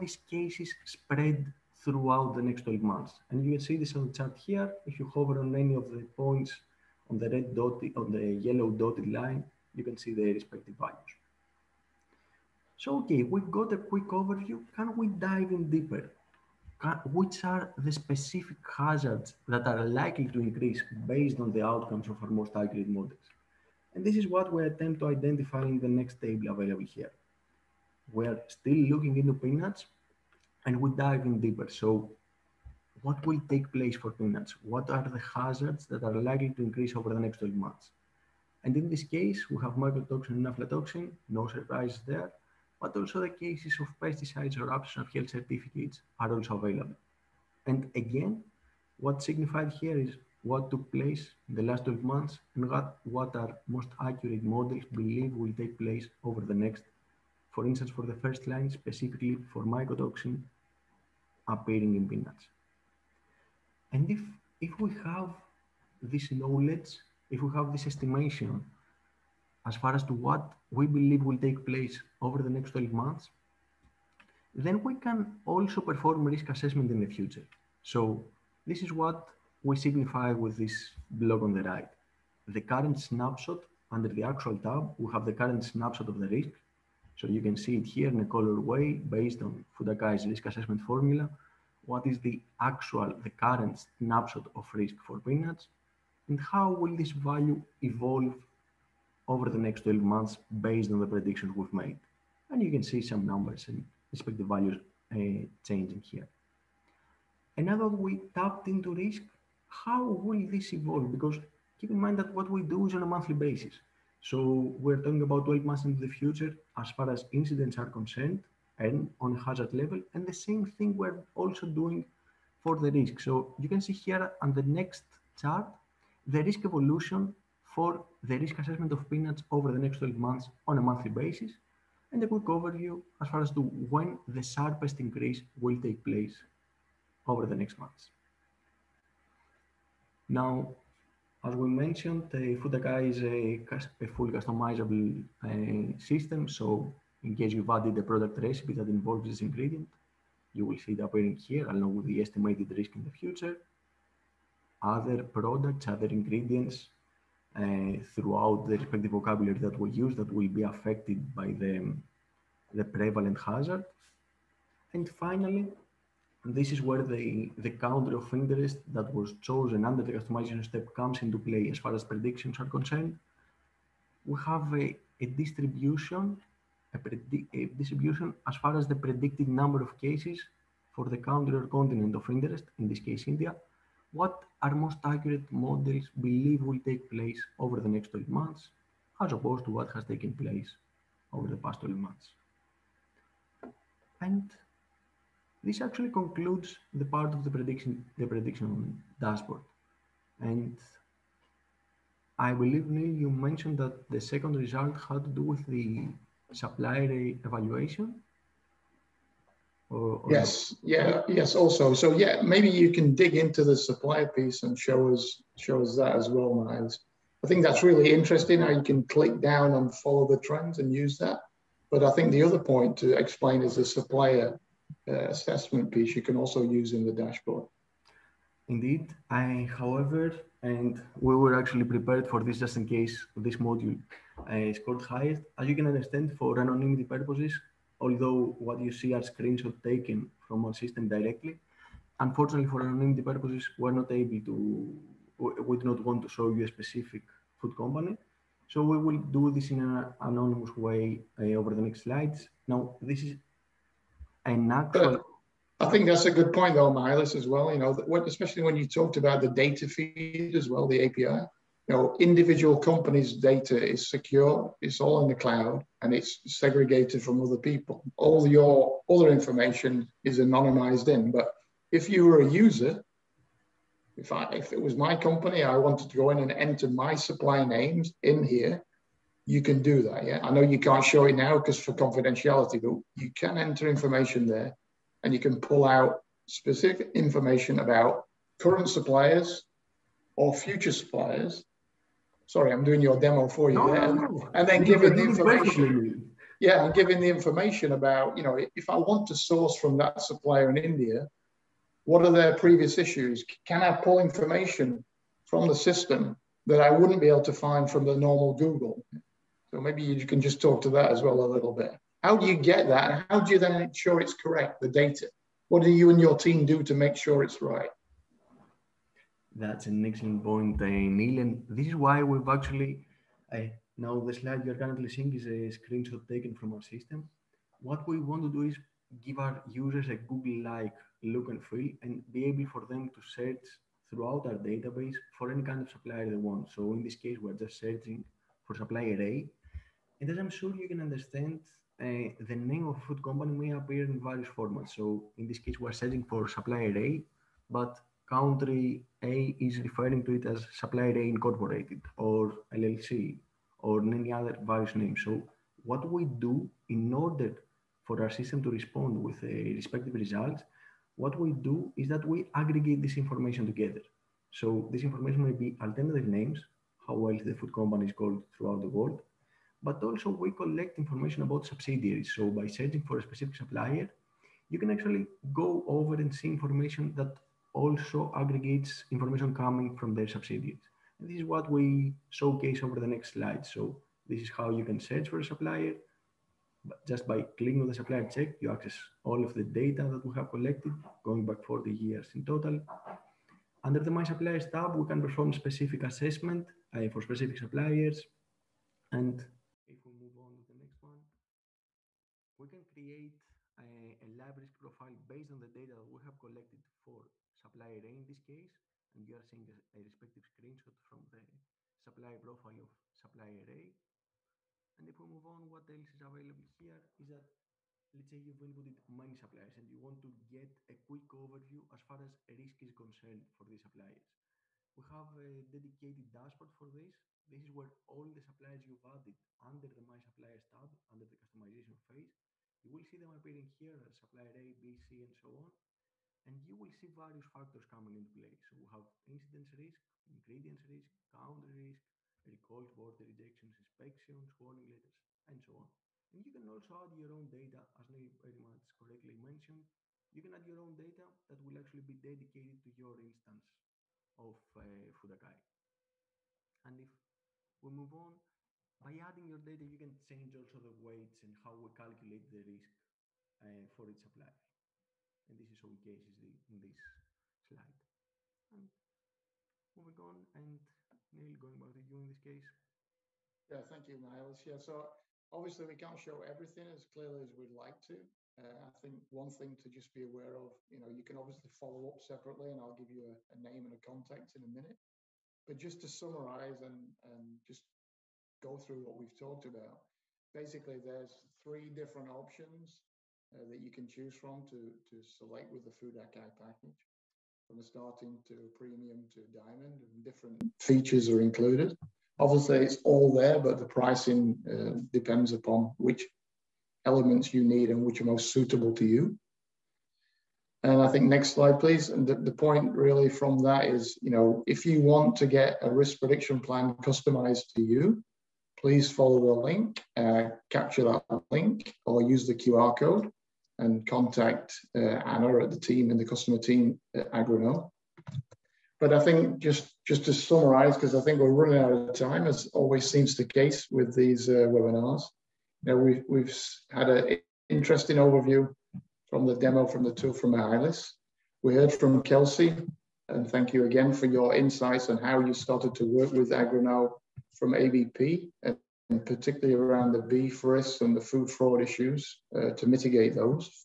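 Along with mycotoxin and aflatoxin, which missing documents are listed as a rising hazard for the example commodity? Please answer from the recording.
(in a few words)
health certificates.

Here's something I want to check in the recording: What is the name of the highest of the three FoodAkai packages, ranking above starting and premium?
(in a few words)
diamond.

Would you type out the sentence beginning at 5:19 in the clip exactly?
That's an excellent point, uh, Neil.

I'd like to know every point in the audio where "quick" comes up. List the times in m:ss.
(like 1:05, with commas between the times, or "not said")
0:13, 2:12, 7:01.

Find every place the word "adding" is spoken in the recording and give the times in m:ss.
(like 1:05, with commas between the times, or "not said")
7:39.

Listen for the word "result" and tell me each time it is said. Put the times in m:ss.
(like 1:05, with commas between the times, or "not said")
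3:24, 6:00.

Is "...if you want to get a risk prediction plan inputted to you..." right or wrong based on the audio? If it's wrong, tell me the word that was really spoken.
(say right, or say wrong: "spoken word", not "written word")
wrong: "customized", not "inputted".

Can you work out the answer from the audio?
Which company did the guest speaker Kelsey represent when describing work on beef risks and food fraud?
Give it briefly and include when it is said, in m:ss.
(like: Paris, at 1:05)
ABP, at 9:07.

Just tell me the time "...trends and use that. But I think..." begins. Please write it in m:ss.
3:40.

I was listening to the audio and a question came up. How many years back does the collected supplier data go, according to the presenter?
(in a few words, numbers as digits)
40 years.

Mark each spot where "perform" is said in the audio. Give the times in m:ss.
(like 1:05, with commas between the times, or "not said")
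1:15, 6:35.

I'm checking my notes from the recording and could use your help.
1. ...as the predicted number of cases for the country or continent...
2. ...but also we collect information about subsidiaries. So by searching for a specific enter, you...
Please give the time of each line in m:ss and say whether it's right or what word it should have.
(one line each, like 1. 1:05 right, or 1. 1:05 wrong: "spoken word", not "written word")
1. 2:58 right
2. 6:09 wrong: "supplier", not "enter".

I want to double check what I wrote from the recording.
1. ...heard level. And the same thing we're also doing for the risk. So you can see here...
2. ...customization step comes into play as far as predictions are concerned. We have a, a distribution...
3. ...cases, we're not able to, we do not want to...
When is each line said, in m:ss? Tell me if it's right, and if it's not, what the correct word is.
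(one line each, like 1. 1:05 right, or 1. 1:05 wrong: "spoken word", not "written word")
1. 1:59 wrong: "hazard", not "heard"
2. 2:50 right
3. 4:03 wrong: "purposes", not "cases".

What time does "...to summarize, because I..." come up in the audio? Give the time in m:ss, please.
8:50.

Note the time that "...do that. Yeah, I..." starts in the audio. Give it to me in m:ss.
4:39.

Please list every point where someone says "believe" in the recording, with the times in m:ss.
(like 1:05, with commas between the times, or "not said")
0:54, 1:10, 3:06, 3:22.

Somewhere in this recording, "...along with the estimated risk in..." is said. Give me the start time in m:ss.
2:31.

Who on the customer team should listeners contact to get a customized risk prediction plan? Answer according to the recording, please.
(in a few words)
Anna.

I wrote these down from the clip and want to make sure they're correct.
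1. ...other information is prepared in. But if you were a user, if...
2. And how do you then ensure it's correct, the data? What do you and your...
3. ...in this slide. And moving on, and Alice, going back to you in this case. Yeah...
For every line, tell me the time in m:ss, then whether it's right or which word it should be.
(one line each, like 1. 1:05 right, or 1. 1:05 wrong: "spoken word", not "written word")
1. 4:29 wrong: "anonymized", not "prepared"
2. 5:13 right
3. 7:46 wrong: "Neil", not "Alice".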